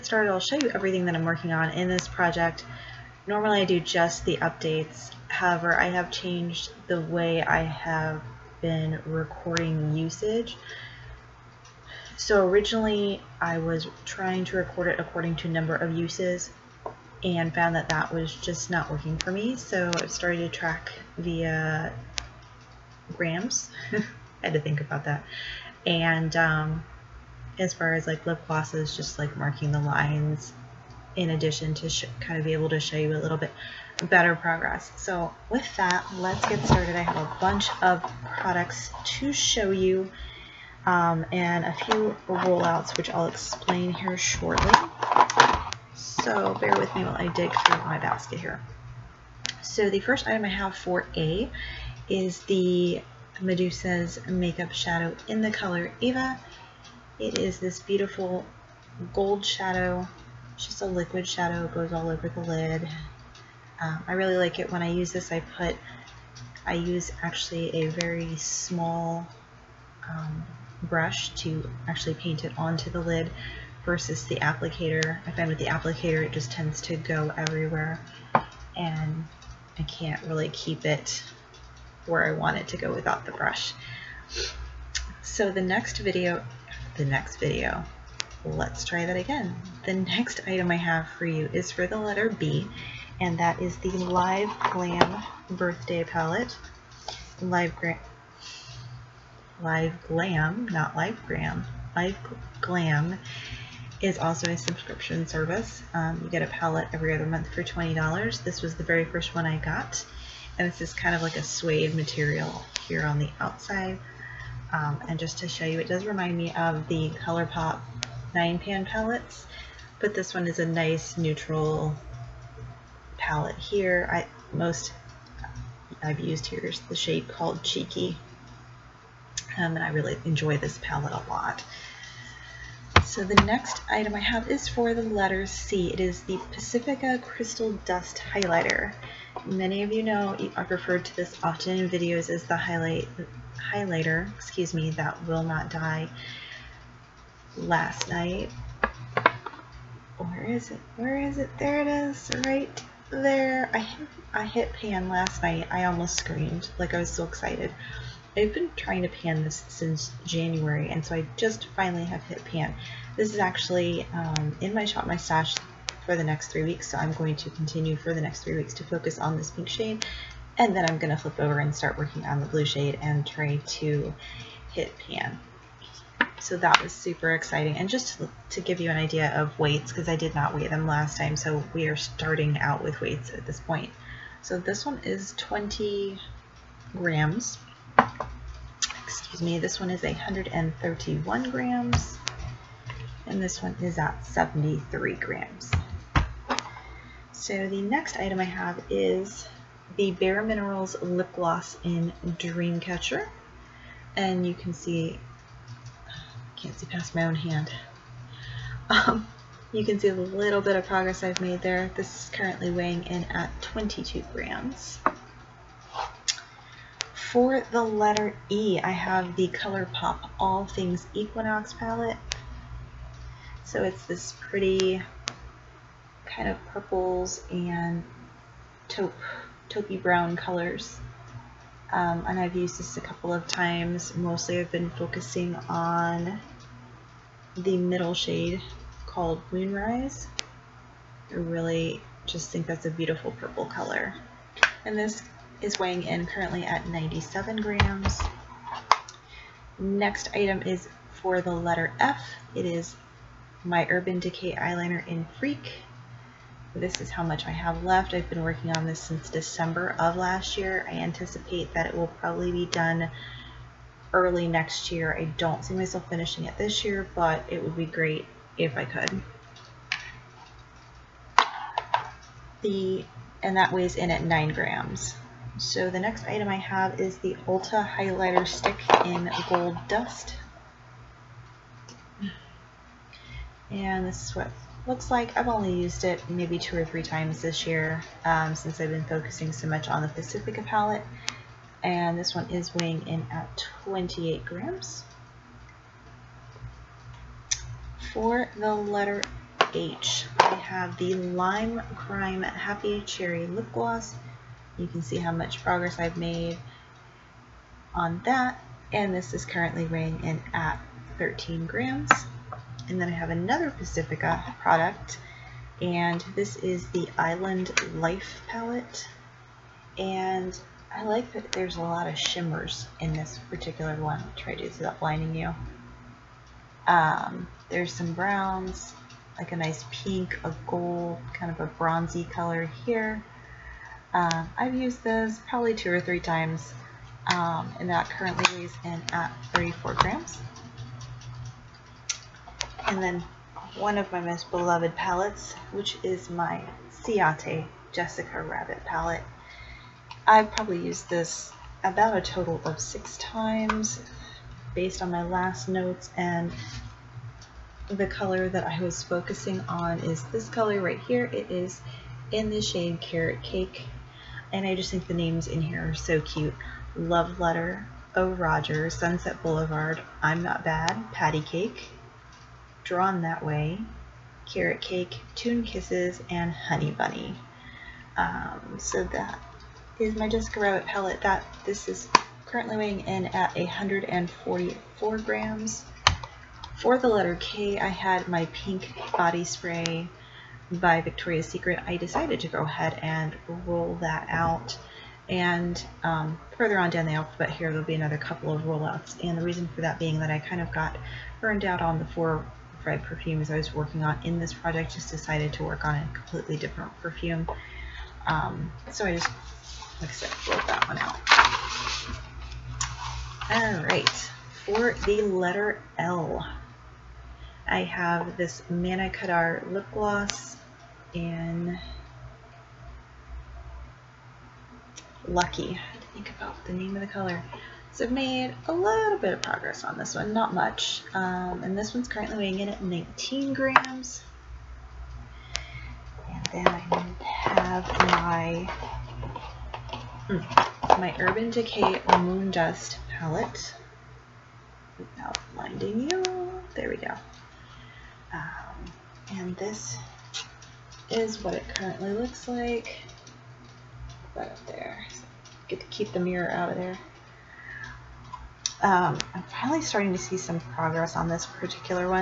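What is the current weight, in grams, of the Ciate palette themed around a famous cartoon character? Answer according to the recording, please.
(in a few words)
144 grams.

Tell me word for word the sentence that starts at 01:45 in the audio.
Um, you get a palette every other month for $20.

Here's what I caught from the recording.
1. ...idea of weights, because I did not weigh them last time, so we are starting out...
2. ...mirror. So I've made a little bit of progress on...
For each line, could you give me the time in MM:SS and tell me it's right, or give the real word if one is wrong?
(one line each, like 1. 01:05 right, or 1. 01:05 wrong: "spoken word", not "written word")
1. 02:58 right
2. 07:07 wrong: "color", not "mirror".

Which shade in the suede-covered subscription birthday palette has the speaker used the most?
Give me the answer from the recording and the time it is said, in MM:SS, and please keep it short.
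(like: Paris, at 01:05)
Cheeky, at 02:07.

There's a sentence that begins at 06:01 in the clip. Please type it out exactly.
It is in the shade Carrot Cake and I just think the names in here are so cute.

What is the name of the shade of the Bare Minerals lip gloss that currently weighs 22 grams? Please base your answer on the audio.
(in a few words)
Dreamcatcher.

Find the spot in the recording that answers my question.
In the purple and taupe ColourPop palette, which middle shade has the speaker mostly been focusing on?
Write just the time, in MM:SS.
03:59.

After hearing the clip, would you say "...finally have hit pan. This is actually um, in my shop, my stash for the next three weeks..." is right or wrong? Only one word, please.
right.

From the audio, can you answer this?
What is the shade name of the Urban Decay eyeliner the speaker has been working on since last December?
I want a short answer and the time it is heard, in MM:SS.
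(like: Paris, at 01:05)
Freak, at 04:15.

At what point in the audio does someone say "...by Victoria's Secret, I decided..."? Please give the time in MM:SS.
06:30.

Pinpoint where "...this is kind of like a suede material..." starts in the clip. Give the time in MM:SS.
01:50.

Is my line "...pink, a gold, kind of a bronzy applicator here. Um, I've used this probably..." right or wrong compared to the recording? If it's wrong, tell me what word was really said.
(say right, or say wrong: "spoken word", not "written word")
wrong: "color", not "applicator".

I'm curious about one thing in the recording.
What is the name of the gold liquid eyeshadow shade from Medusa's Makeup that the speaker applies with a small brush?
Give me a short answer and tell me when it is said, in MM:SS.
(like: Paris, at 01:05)
Eva, at 00:56.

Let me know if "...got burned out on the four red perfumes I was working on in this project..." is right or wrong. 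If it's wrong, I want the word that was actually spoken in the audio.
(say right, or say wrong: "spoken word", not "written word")
right.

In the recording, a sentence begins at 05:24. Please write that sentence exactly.
I'll try to do without blinding you.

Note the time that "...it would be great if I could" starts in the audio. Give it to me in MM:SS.
04:27.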